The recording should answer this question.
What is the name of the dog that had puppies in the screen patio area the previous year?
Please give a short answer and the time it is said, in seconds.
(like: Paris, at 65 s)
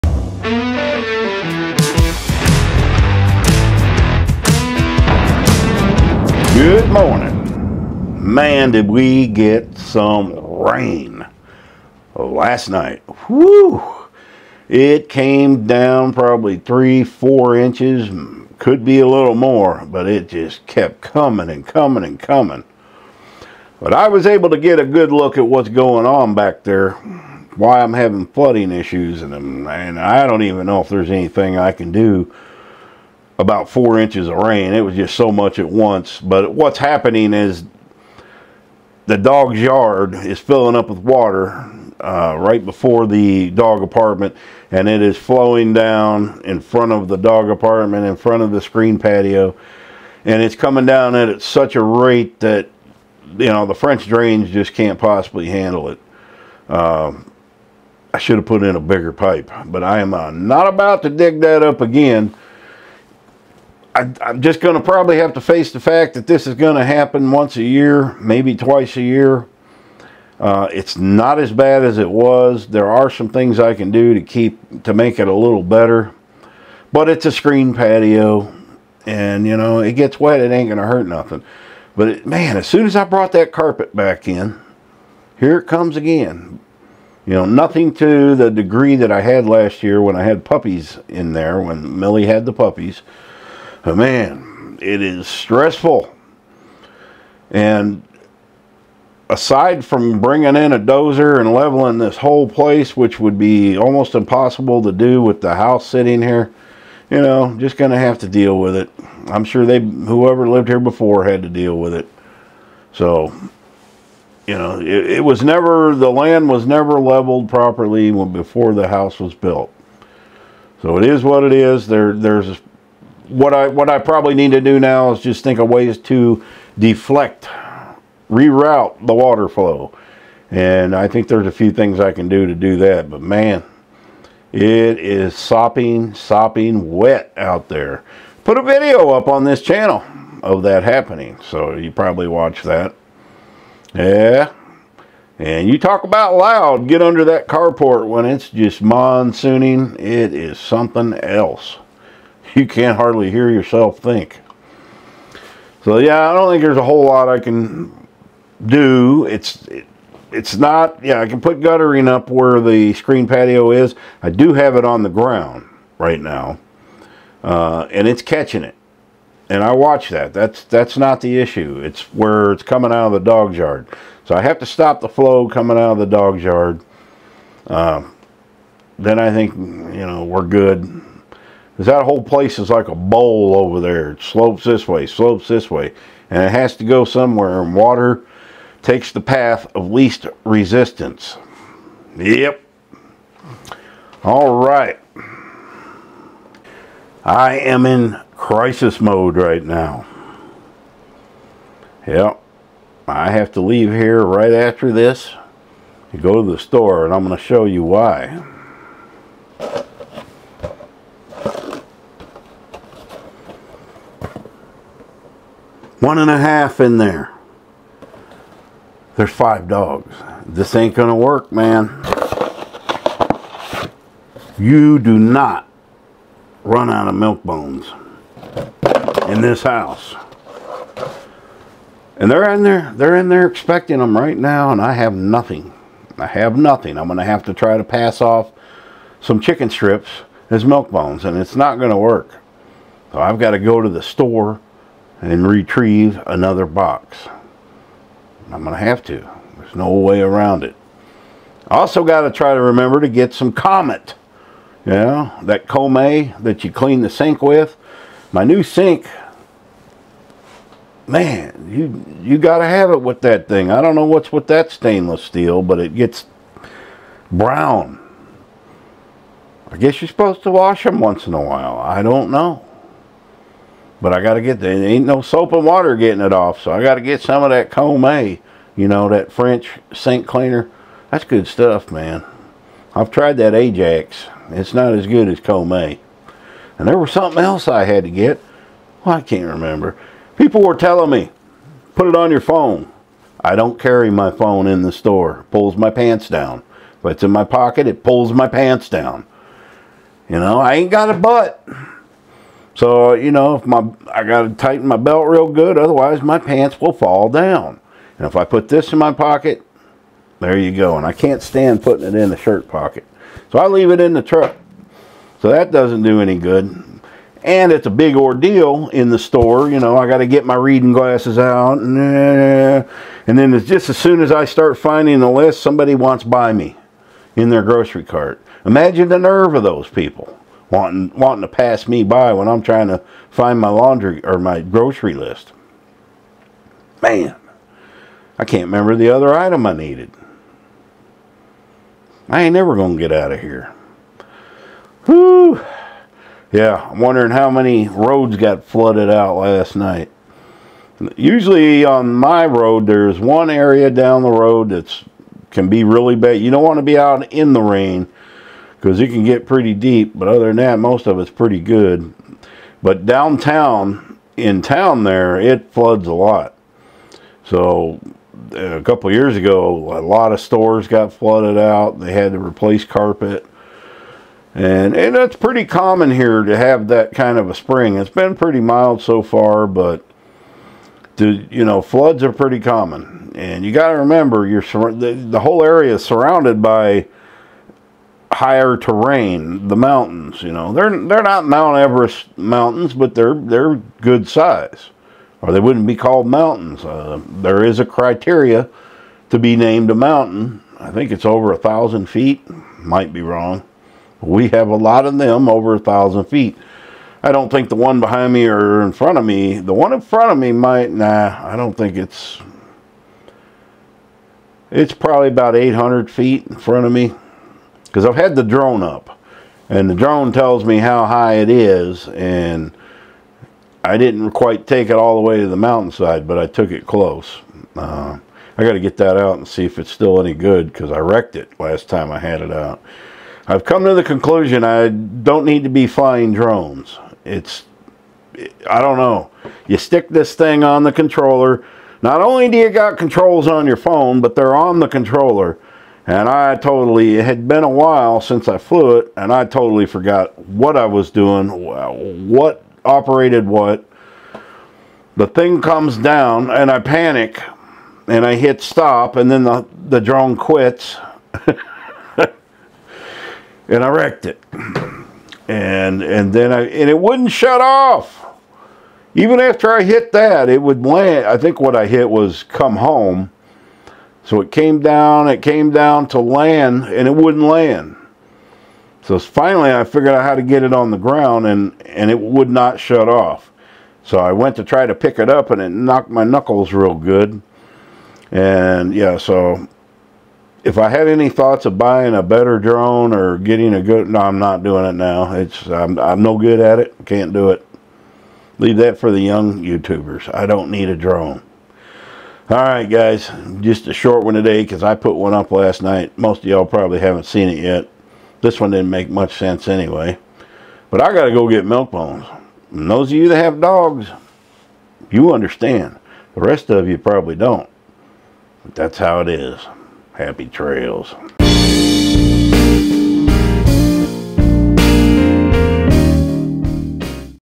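Millie, at 91 s.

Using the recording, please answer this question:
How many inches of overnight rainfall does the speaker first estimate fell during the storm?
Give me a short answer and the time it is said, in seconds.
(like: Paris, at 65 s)
3 or 4 inches, at 16 s.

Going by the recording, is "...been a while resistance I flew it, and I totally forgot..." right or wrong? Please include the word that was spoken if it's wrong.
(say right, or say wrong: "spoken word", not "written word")
wrong: "since", not "resistance".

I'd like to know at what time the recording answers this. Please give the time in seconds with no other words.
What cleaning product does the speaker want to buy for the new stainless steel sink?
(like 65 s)
253 s.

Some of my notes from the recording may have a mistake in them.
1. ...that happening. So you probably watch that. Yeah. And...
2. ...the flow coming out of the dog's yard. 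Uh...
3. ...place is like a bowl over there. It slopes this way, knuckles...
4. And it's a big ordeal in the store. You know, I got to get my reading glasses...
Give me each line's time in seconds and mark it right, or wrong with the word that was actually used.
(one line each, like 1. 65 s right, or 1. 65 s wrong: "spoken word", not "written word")
1. 140 s right
2. 175 s right
3. 182 s wrong: "slopes", not "knuckles"
4. 317 s right.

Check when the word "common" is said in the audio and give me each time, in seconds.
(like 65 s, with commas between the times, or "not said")
375 s, 382 s.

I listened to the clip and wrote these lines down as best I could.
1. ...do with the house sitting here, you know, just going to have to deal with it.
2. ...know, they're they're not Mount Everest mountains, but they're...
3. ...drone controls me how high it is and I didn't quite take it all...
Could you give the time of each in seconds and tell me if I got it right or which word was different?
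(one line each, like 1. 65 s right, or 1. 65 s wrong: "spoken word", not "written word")
1. 104 s right
2. 390 s right
3. 419 s wrong: "tells", not "controls".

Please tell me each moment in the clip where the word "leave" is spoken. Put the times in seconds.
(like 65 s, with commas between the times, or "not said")
203 s, 313 s, 498 s.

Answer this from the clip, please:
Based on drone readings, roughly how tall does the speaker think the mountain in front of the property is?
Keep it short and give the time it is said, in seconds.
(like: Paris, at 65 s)
800 feet, at 415 s.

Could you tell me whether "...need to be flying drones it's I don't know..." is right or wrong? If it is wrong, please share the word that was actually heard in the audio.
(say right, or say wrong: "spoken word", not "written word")
right.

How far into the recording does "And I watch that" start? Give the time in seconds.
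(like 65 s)
169 s.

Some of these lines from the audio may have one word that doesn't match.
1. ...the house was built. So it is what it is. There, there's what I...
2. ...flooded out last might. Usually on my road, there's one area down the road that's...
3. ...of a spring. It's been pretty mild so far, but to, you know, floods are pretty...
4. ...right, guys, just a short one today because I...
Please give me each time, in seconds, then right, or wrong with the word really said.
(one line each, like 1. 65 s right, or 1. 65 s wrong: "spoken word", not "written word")
1. 118 s right
2. 348 s wrong: "night", not "might"
3. 377 s right
4. 502 s right.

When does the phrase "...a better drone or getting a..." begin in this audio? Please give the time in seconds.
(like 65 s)
492 s.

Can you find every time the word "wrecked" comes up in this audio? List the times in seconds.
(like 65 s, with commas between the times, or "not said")
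430 s, 463 s.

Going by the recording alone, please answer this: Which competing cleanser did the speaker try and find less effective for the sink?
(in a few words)
Ajax.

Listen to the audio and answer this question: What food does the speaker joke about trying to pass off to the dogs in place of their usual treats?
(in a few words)
Chicken strips.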